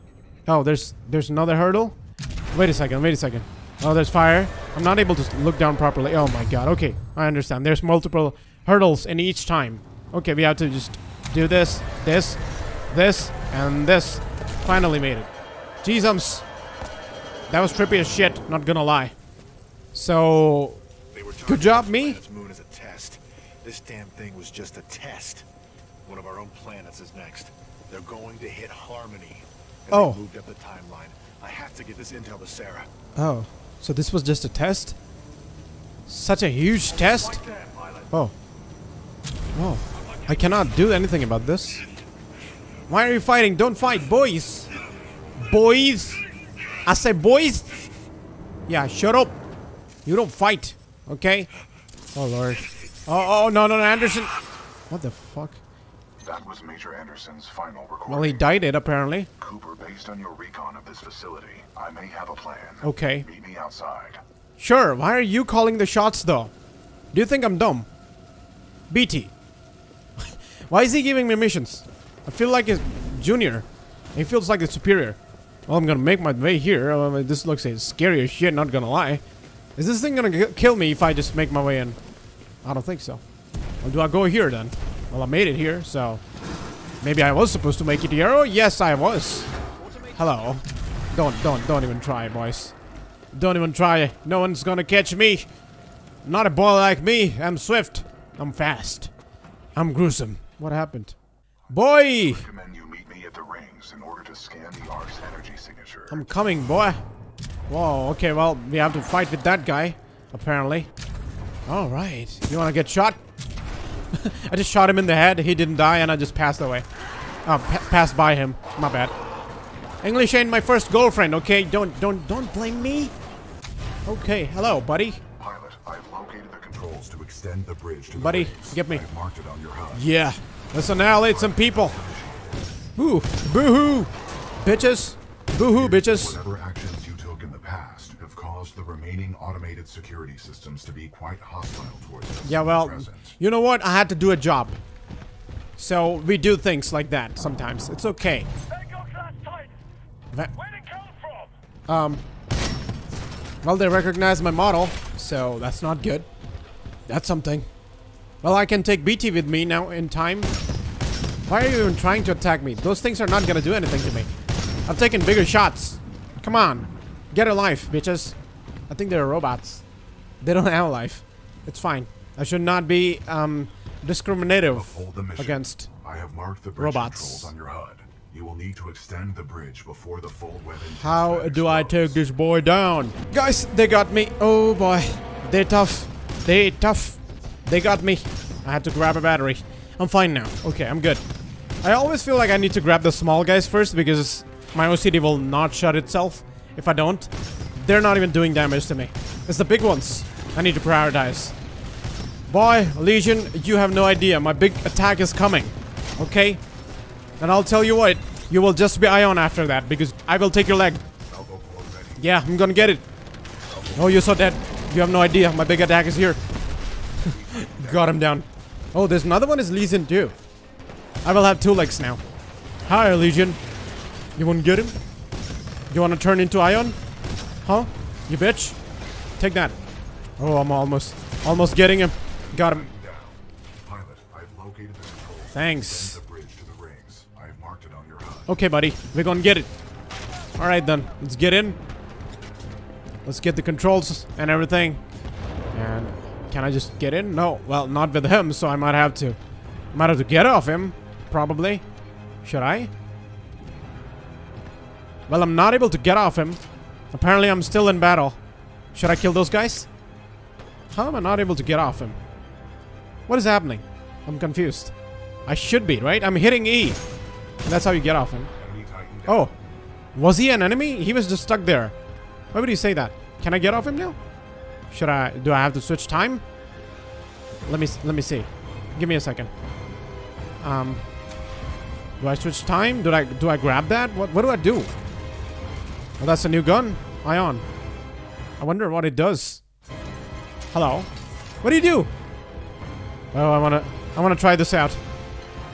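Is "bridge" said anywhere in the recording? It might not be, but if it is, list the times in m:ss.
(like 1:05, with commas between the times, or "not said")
2:07, 2:59.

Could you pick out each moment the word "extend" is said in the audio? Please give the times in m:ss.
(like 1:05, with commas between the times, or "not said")
2:07, 2:58.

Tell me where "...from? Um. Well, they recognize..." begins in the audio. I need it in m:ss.
2:31.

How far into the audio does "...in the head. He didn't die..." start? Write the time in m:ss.
1:54.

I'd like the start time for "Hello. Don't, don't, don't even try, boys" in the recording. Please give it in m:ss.
1:30.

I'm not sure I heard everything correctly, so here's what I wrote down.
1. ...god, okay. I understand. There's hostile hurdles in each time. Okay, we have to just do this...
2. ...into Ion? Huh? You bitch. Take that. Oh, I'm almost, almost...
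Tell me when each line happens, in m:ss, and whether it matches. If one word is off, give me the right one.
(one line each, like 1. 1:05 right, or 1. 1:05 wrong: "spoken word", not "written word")
1. 0:06 wrong: "multiple", not "hostile"
2. 3:46 right.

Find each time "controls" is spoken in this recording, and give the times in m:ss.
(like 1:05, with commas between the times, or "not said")
2:06, 4:03.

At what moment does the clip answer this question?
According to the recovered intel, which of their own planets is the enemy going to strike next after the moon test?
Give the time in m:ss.
0:28.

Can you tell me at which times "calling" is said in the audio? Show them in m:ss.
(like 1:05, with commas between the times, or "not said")
1:05.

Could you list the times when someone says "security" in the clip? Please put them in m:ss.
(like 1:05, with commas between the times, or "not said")
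2:19.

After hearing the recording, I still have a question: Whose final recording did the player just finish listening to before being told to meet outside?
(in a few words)
Major Anderson.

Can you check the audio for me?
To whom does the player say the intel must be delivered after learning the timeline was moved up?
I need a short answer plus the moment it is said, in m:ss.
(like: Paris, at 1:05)
Sarah, at 0:32.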